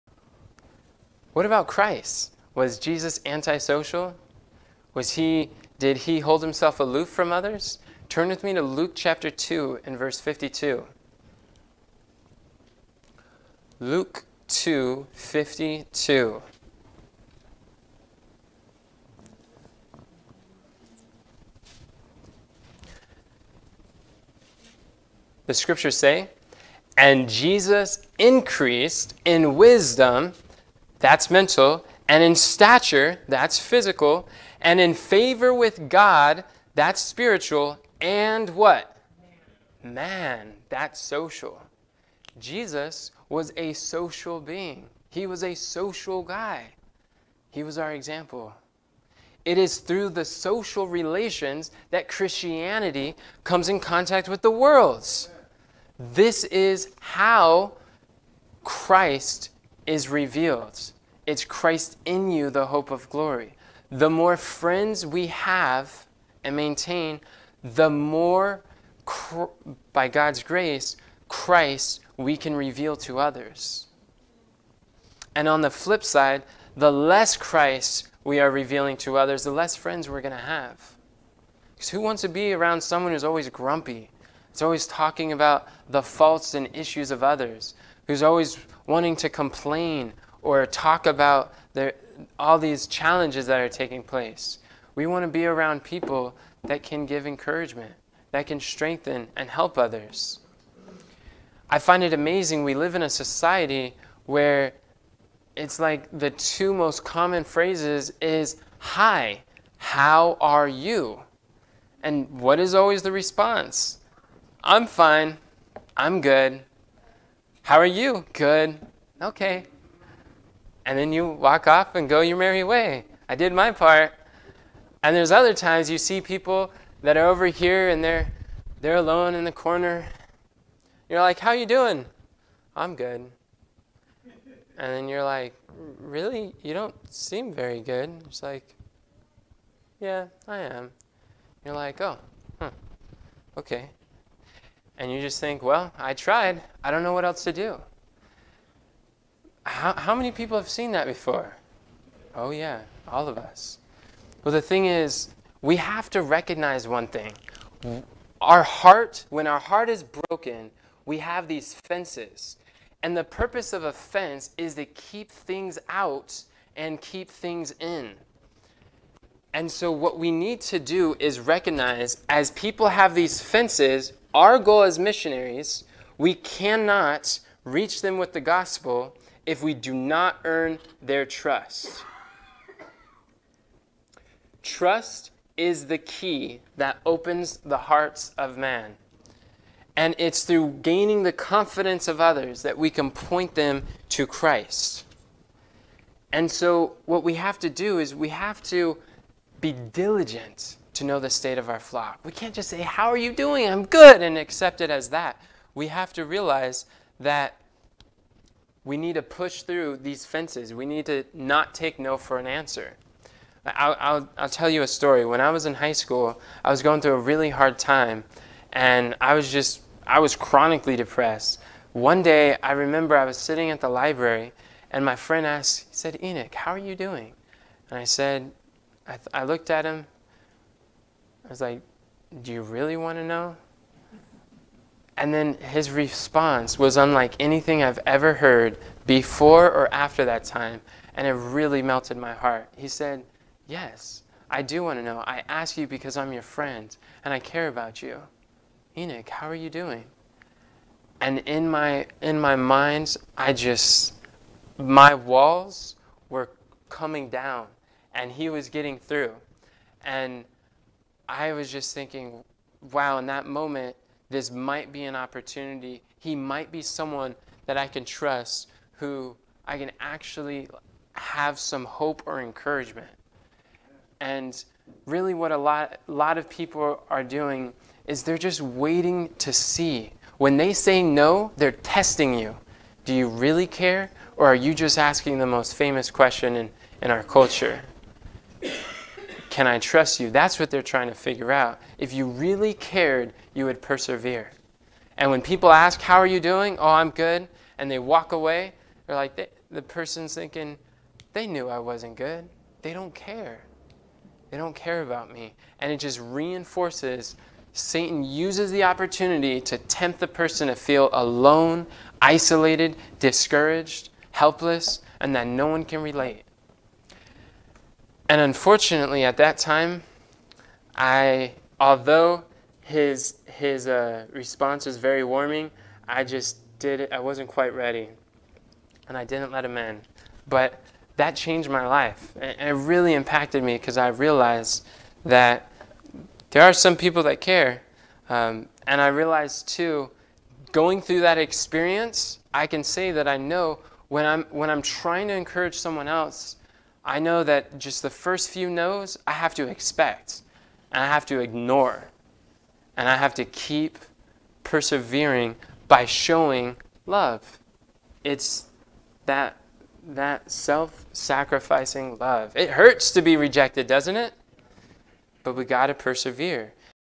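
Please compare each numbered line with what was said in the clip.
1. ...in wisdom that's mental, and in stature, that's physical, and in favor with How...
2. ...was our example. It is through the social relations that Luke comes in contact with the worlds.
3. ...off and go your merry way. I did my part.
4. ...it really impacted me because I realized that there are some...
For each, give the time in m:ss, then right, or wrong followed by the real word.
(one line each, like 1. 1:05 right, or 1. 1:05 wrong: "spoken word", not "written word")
1. 0:29 wrong: "God", not "How"
2. 0:47 wrong: "Christianity", not "Luke"
3. 2:01 right
4. 5:32 right.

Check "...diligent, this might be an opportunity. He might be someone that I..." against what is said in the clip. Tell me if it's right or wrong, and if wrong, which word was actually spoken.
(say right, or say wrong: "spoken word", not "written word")
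wrong: "moment", not "diligent".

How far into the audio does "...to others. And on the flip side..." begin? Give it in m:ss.
1:12.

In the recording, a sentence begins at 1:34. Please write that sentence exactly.
We want to be around people that can give encouragement, that can strengthen and help others.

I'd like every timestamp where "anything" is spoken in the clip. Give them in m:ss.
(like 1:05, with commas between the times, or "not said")
3:57.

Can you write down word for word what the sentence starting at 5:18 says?
And unfortunately, at that time, I, although his, his uh, response was very warming, I just did it, I wasn't quite ready.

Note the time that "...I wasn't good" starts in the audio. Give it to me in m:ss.
5:01.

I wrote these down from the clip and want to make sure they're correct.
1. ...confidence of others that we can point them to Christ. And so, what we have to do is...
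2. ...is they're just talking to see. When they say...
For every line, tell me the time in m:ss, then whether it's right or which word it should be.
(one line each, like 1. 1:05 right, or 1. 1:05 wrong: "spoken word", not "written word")
1. 3:11 right
2. 4:38 wrong: "waiting", not "talking".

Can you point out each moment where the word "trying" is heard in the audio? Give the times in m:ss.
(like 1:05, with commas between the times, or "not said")
4:50, 5:44.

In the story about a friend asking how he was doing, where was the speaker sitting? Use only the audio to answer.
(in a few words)
The library.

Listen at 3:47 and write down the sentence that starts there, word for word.
And I said, I, I looked at him was like, Do you really want to know?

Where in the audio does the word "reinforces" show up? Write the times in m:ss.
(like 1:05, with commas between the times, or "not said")
5:06.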